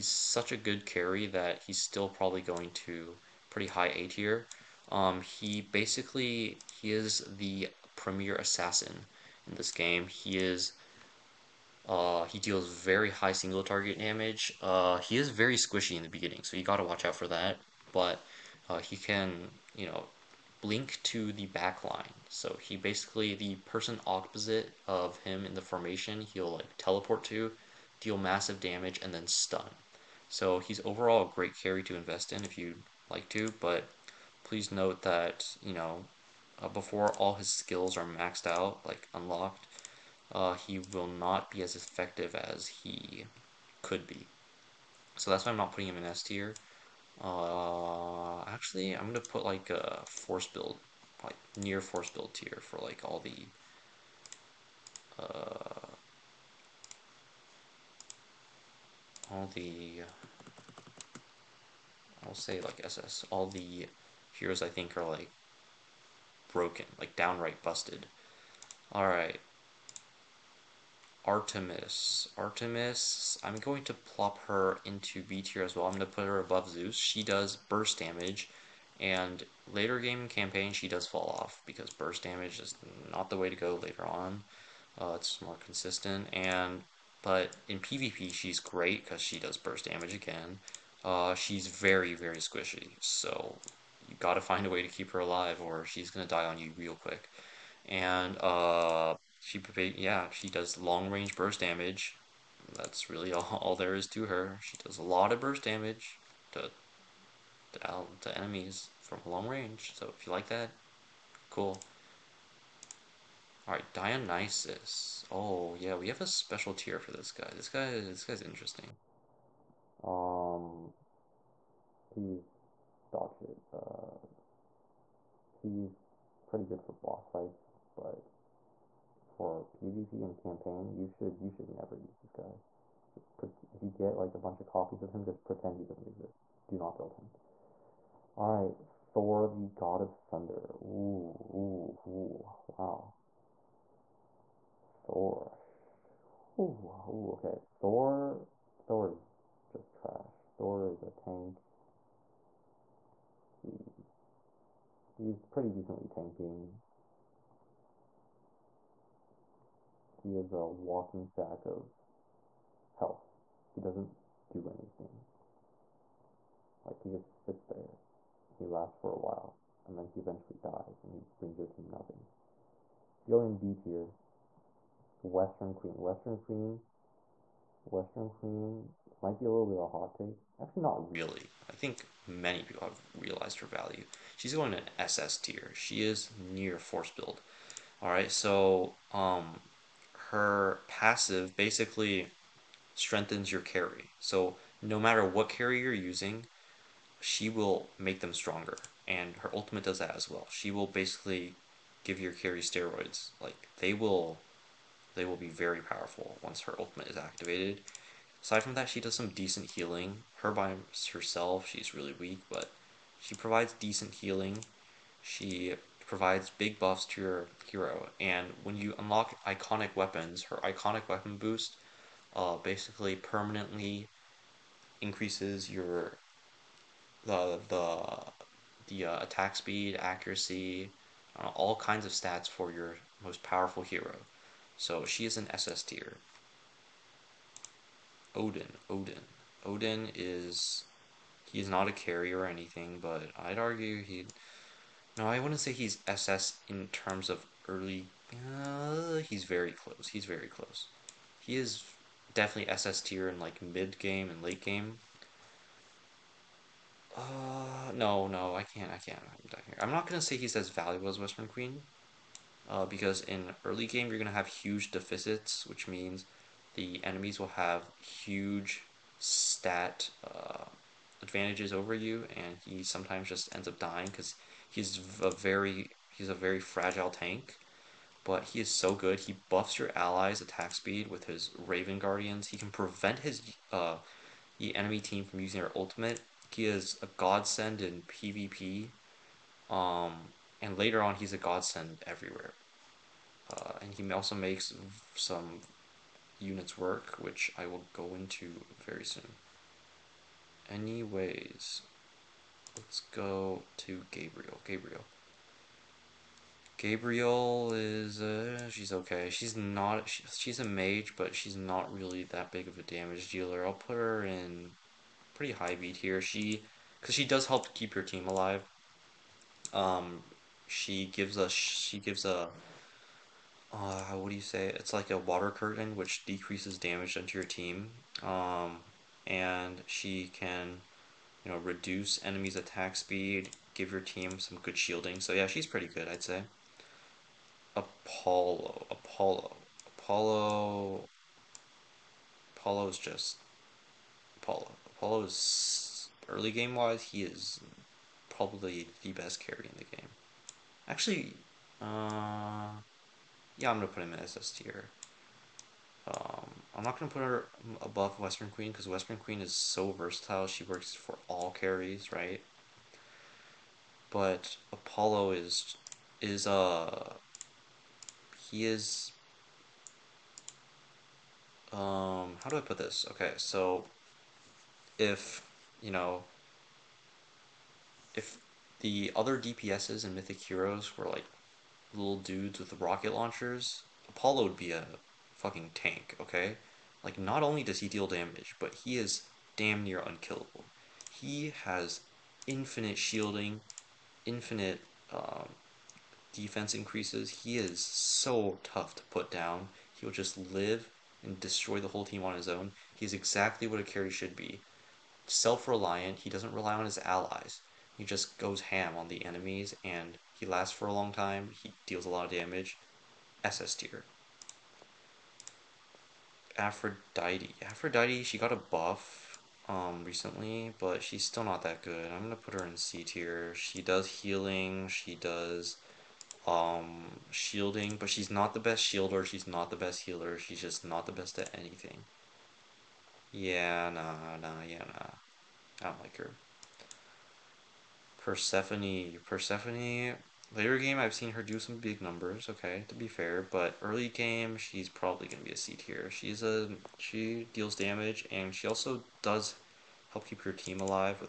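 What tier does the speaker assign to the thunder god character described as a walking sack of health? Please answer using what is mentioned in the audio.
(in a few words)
D tier.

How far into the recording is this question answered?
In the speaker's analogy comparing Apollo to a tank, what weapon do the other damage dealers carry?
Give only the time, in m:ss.
6:22.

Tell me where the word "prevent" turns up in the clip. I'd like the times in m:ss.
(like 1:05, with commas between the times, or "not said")
4:42.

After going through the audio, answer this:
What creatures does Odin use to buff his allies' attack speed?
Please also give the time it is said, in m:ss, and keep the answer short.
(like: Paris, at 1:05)
Raven Guardians, at 4:41.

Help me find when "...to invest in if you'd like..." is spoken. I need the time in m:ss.
0:31.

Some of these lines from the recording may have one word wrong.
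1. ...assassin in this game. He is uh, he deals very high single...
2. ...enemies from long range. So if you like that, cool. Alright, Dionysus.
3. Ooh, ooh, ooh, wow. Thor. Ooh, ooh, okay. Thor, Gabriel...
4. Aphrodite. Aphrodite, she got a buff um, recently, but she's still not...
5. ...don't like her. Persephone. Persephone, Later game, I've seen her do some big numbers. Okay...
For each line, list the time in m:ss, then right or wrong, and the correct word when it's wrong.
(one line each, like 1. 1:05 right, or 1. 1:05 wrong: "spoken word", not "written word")
1. 0:08 right
2. 1:48 right
3. 2:20 wrong: "Thor", not "Gabriel"
4. 6:56 right
5. 7:15 right.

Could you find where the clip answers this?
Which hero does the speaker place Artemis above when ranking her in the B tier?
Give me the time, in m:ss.
1:16.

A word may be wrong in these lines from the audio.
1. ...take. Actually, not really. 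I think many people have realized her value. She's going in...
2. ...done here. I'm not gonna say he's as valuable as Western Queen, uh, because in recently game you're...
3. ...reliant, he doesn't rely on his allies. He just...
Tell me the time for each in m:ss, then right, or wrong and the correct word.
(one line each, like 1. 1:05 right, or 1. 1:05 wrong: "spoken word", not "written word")
1. 3:00 right
2. 4:19 wrong: "early", not "recently"
3. 6:45 right.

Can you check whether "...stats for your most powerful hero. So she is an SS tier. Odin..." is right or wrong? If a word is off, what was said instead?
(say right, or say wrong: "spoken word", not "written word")
right.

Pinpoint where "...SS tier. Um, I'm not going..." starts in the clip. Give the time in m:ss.
5:54.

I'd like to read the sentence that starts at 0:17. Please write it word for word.
But uh, he can, you know, blink to the back line.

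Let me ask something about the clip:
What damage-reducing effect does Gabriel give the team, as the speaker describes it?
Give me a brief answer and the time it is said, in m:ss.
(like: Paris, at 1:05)
Water curtain, at 5:25.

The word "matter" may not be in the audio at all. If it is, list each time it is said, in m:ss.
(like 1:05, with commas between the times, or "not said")
3:14.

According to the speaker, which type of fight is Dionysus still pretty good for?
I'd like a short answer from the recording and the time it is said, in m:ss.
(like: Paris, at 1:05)
Boss fights, at 2:07.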